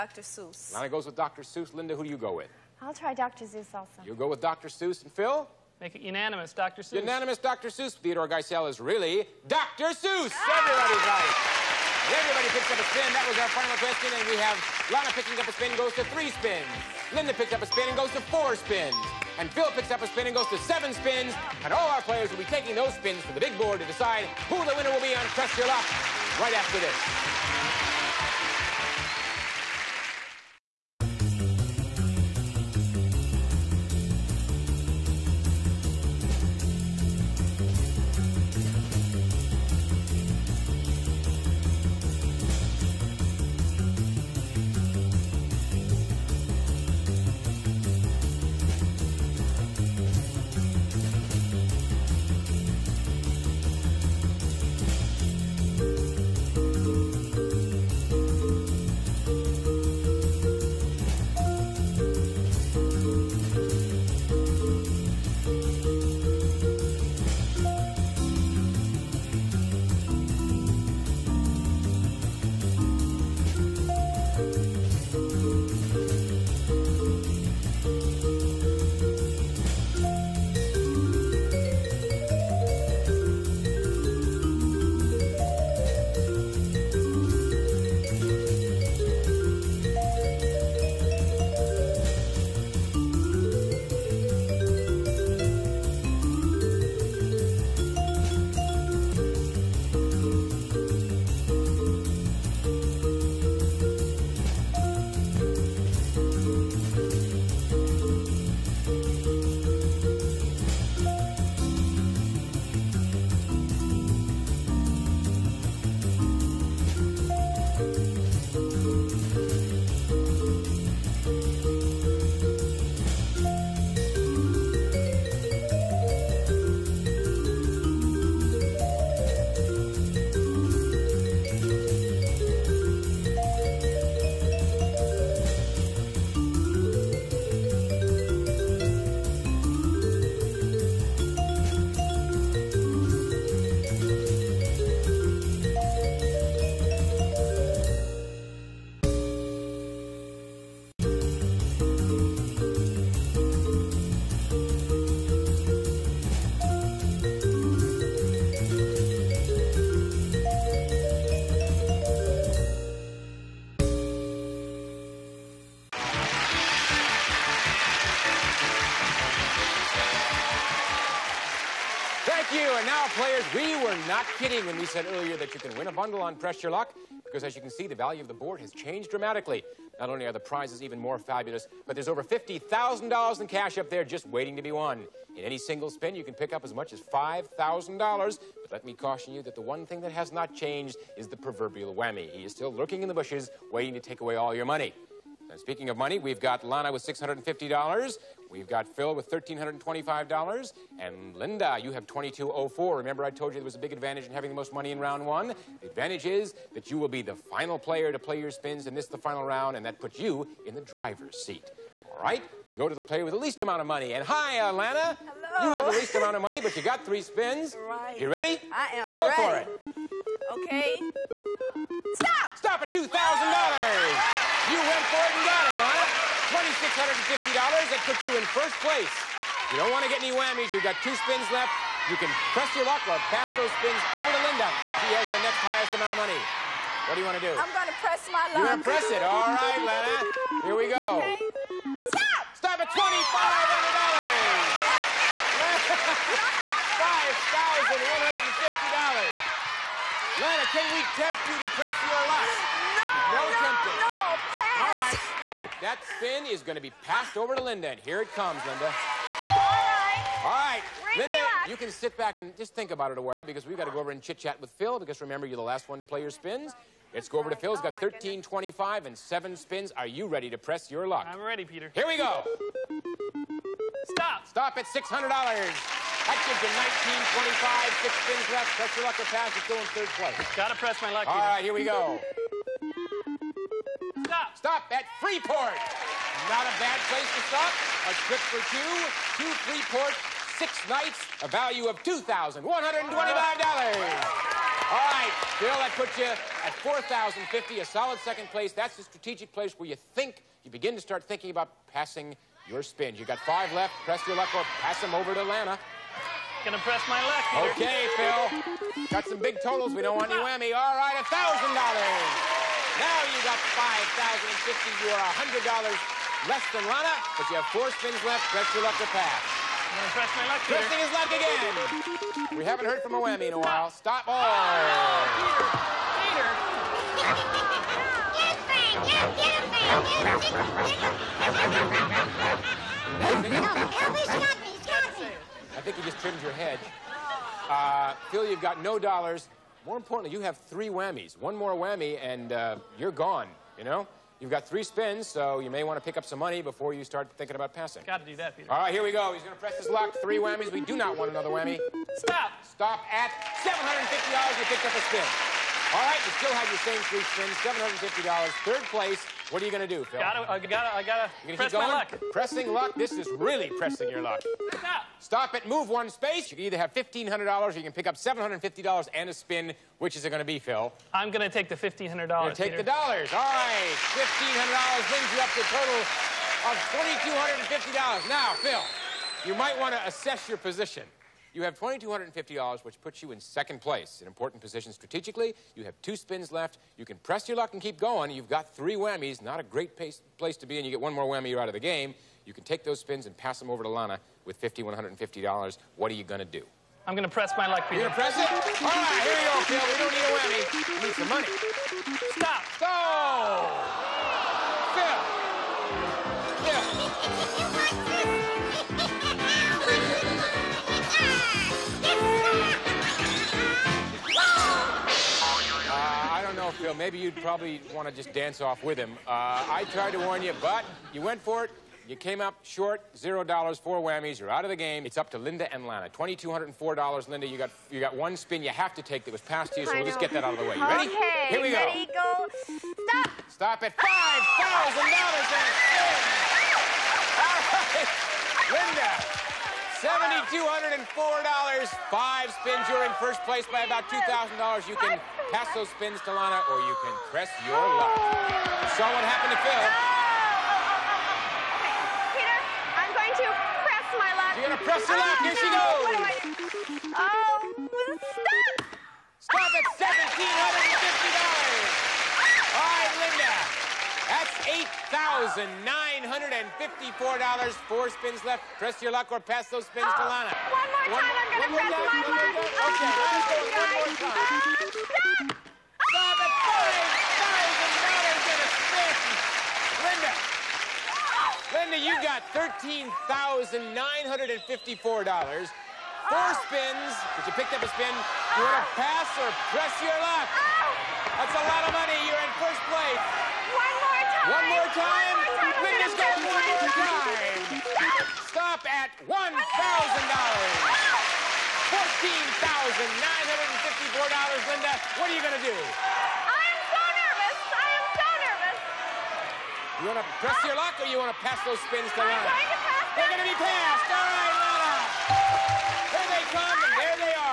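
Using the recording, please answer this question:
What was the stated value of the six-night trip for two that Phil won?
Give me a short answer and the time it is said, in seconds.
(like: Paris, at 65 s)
$2,125, at 292 s.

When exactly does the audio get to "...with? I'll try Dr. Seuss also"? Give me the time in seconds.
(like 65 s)
2 s.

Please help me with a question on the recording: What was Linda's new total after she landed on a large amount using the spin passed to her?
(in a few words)
$7,204.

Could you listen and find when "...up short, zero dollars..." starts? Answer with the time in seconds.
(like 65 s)
422 s.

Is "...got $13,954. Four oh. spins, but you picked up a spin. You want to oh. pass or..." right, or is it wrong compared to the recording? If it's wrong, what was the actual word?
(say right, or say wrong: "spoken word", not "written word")
right.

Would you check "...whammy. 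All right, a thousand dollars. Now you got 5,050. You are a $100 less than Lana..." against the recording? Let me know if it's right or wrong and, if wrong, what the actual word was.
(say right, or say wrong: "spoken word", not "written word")
right.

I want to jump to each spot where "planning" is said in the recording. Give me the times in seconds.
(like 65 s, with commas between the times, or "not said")
not said.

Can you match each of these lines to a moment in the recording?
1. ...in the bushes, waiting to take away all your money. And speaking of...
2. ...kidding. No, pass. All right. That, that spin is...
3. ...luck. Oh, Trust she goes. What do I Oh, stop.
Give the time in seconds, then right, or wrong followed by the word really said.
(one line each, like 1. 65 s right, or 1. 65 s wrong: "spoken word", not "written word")
1. 193 s right
2. 253 s wrong: "tempting", not "kidding"
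3. 455 s wrong: "Here", not "Trust".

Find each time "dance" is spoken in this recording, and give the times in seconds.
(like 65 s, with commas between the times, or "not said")
418 s.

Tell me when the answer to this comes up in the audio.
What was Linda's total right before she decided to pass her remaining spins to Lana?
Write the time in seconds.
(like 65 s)
499 s.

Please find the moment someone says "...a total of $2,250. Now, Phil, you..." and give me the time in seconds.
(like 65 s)
375 s.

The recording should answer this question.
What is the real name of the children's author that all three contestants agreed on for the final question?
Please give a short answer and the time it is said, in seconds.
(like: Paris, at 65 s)
Theodore Geisel, at 7 s.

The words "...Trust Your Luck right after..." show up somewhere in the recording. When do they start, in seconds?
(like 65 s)
25 s.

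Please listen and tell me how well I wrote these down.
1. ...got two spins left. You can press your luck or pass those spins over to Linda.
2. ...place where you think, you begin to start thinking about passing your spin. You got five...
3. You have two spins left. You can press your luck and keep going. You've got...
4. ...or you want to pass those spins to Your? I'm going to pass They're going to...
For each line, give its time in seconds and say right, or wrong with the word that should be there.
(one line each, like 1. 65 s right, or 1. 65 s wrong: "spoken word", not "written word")
1. 230 s right
2. 299 s right
3. 385 s right
4. 510 s wrong: "Lana", not "Your".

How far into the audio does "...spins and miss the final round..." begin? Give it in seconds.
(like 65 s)
208 s.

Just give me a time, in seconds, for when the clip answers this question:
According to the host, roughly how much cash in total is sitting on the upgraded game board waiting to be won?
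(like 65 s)
182 s.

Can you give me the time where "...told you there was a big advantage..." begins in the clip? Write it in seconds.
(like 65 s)
203 s.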